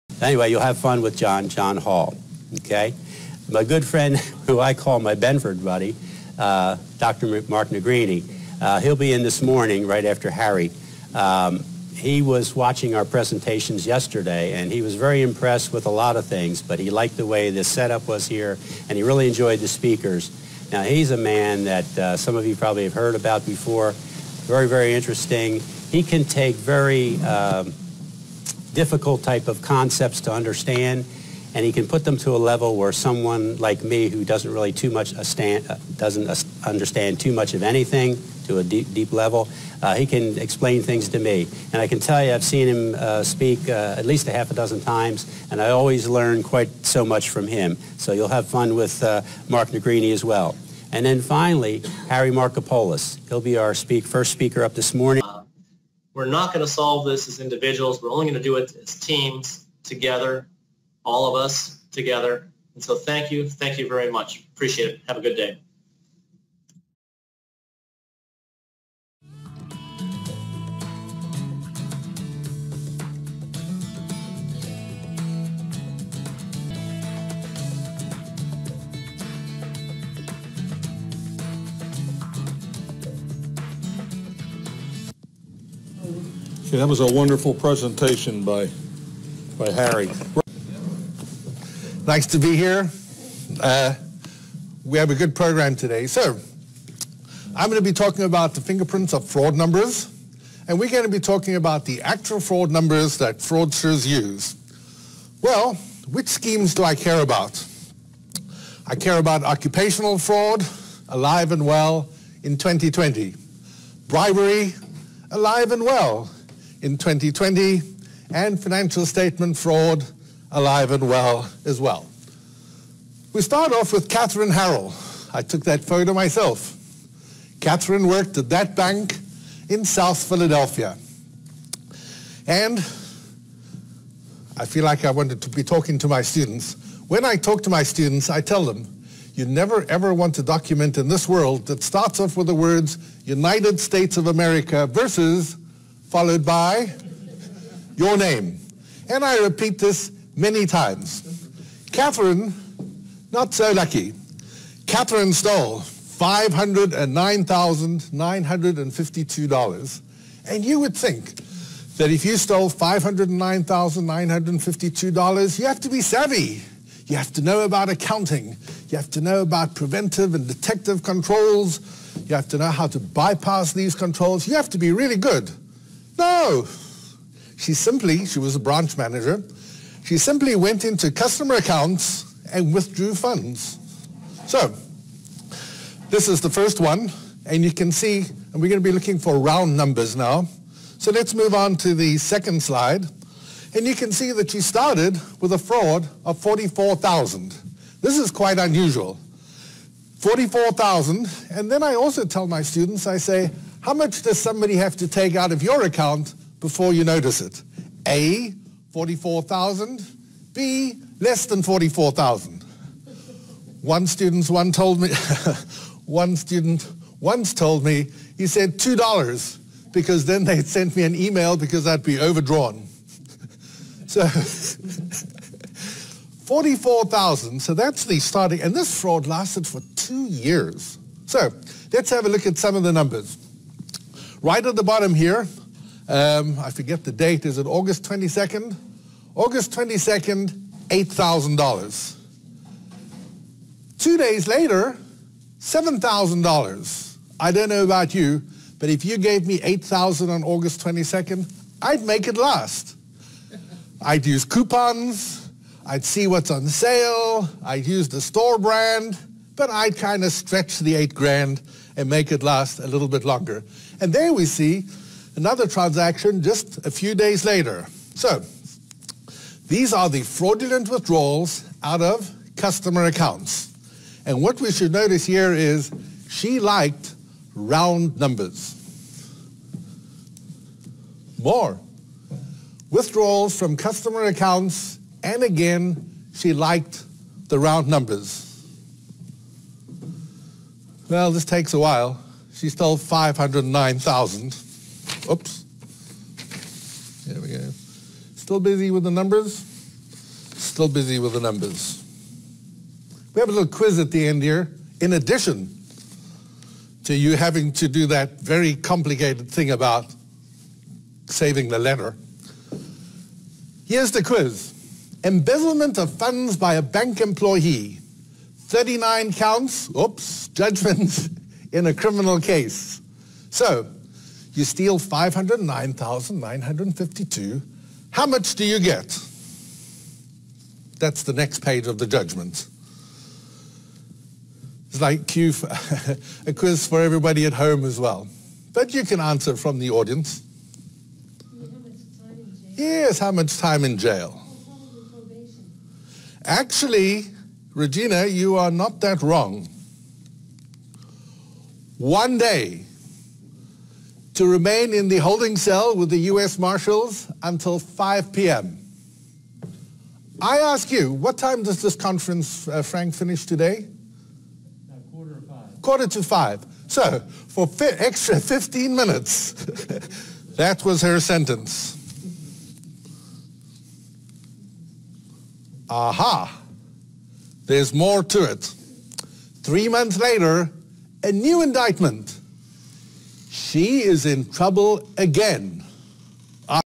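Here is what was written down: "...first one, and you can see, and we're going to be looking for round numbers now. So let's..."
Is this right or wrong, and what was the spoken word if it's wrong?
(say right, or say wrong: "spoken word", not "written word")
right.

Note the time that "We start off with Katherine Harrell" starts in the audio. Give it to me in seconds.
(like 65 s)
123 s.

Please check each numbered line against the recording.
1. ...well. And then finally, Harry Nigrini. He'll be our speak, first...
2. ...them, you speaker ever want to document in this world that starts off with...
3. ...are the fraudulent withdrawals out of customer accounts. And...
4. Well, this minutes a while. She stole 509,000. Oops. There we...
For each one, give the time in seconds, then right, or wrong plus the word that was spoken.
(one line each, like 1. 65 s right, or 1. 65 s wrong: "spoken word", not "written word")
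1. 50 s wrong: "Markopolos", not "Nigrini"
2. 138 s wrong: "never", not "speaker"
3. 269 s right
4. 291 s wrong: "takes", not "minutes".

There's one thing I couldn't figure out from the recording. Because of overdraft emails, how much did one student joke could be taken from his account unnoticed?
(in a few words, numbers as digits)
$2.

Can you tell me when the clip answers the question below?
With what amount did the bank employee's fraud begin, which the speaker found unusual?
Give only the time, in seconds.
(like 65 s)
194 s.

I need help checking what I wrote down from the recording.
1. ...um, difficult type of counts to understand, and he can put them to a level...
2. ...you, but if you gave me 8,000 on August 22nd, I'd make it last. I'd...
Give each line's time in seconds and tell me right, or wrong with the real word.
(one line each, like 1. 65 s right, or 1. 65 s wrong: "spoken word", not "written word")
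1. 27 s wrong: "concepts", not "counts"
2. 248 s right.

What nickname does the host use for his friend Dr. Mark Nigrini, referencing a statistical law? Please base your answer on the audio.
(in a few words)
Benford buddy.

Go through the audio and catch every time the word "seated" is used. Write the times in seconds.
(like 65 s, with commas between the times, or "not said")
not said.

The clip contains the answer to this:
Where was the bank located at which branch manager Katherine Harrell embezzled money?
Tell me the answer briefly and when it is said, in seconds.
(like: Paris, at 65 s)
South Philadelphia, at 129 s.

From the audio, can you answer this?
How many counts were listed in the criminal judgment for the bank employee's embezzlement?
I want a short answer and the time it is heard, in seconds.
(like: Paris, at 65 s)
39, at 318 s.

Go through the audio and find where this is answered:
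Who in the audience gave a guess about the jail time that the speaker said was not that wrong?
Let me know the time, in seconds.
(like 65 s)
347 s.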